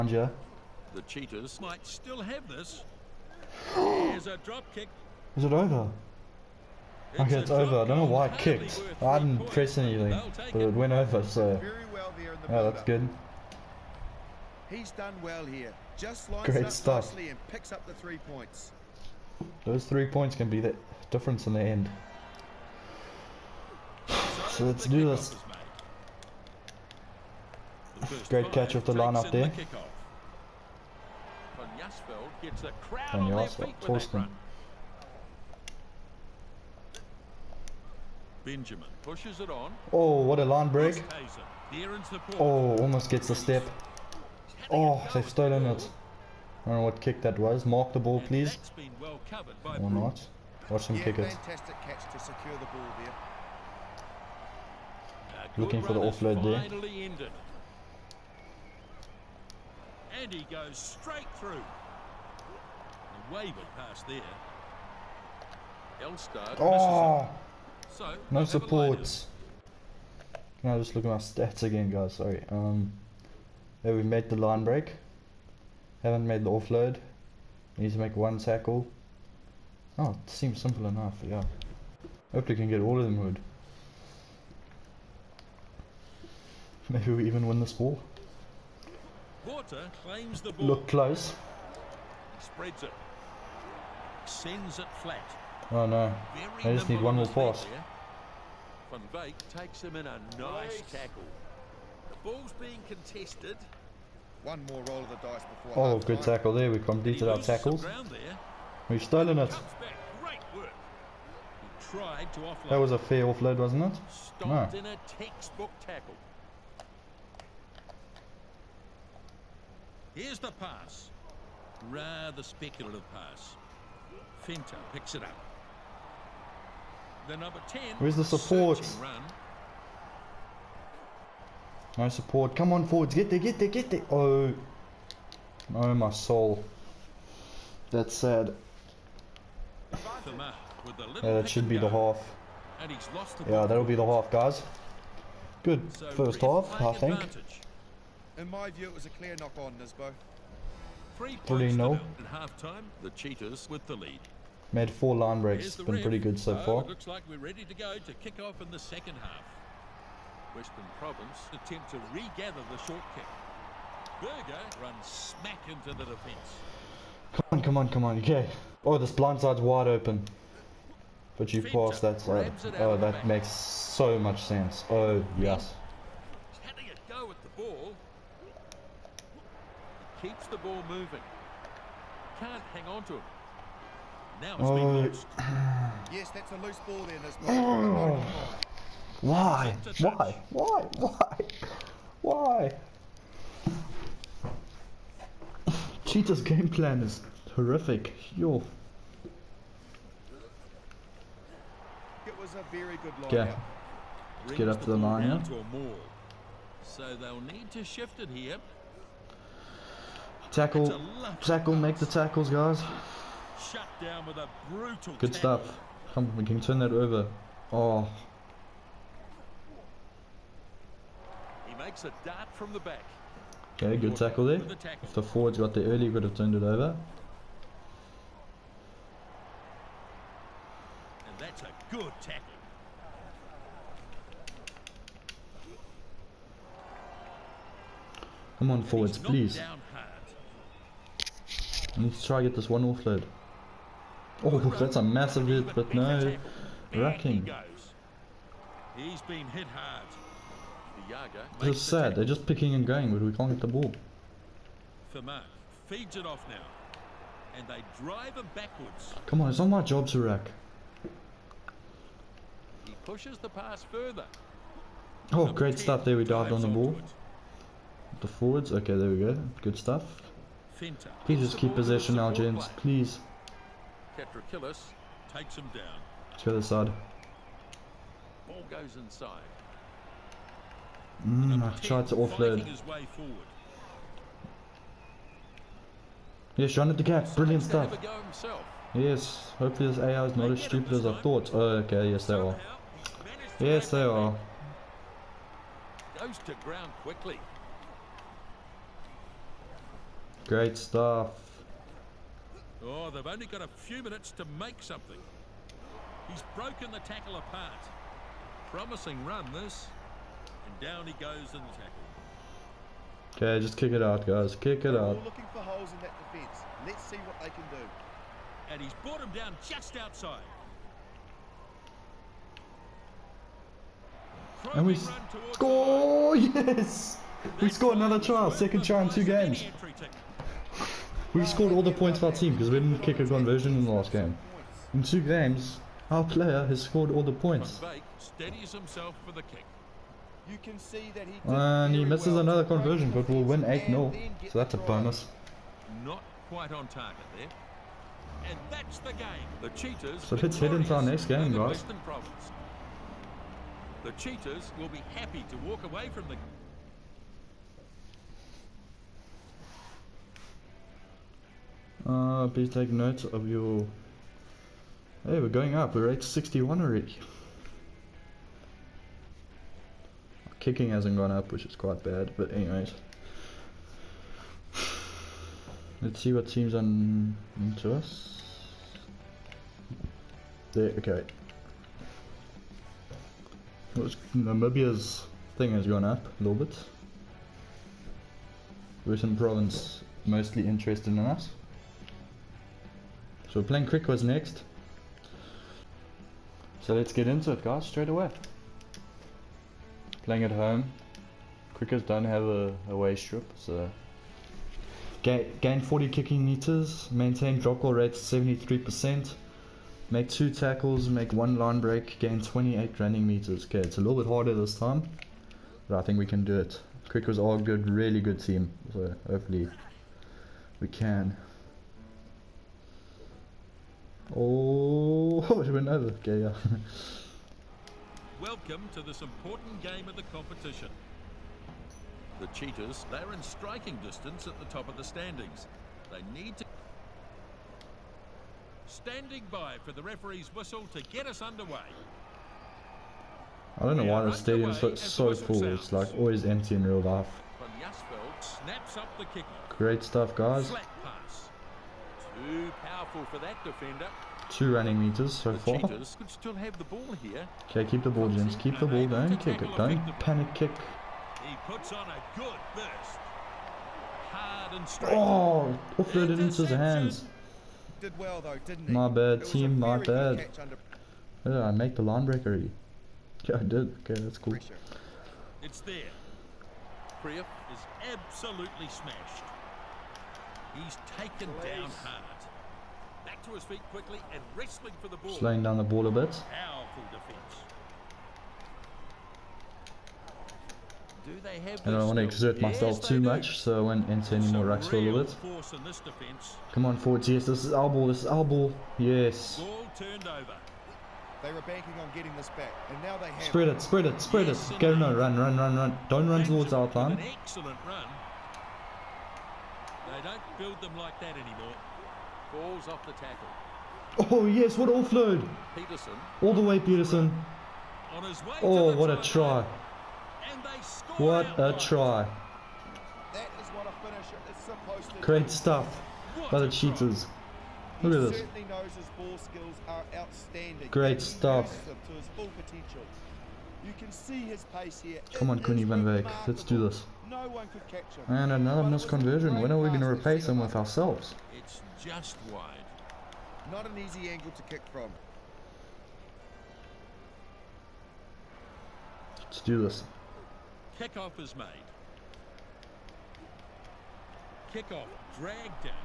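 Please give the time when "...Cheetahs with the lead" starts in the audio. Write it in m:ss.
2:33.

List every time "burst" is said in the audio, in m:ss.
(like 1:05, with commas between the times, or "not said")
7:42.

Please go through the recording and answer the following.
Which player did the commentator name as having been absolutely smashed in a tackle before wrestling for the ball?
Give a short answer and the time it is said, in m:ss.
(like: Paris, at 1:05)
Krief, at 7:57.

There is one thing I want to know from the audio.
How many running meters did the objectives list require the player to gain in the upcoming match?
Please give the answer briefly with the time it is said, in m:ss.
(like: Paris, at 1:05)
28, at 6:52.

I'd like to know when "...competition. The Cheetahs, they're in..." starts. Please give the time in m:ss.
7:10.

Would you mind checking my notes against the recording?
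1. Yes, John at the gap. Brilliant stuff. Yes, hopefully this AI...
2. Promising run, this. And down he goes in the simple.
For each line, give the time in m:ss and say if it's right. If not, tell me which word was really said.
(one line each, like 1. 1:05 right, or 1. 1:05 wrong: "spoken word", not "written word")
1. 4:46 right
2. 5:08 wrong: "tackle", not "simple".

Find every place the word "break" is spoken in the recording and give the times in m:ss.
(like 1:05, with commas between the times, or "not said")
0:40, 1:14, 2:35, 6:51.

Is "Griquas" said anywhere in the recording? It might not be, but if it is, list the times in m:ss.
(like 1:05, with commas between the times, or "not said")
6:33, 6:41, 6:57.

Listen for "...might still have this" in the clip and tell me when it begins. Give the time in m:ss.
0:01.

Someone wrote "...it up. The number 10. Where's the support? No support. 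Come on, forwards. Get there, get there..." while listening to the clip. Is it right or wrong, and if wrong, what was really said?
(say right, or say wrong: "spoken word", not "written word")
right.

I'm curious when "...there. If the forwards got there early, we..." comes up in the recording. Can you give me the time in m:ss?
3:44.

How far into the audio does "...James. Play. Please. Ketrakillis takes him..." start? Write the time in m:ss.
4:32.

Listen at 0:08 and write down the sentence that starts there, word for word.
I didn't press anything, but it went over, so...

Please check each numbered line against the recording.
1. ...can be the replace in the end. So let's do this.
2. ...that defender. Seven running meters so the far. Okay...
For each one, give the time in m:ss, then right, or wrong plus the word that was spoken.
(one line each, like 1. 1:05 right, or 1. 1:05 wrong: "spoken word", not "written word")
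1. 0:20 wrong: "difference", not "replace"
2. 7:33 wrong: "Two", not "Seven".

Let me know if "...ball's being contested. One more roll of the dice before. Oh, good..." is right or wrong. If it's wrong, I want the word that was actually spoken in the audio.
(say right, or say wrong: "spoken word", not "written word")
right.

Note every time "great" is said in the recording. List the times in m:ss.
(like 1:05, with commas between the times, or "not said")
0:16, 0:28, 4:25, 5:00, 7:29, 8:45, 8:50.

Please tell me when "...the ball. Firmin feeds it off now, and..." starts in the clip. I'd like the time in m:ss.
4:13.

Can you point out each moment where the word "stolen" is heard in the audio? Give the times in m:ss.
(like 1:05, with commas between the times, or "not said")
0:45, 1:49.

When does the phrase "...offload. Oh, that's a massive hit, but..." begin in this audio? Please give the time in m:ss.
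4:02.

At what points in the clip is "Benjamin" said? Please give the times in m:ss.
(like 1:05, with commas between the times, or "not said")
0:38.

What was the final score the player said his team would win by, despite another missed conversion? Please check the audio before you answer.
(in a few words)
8-0.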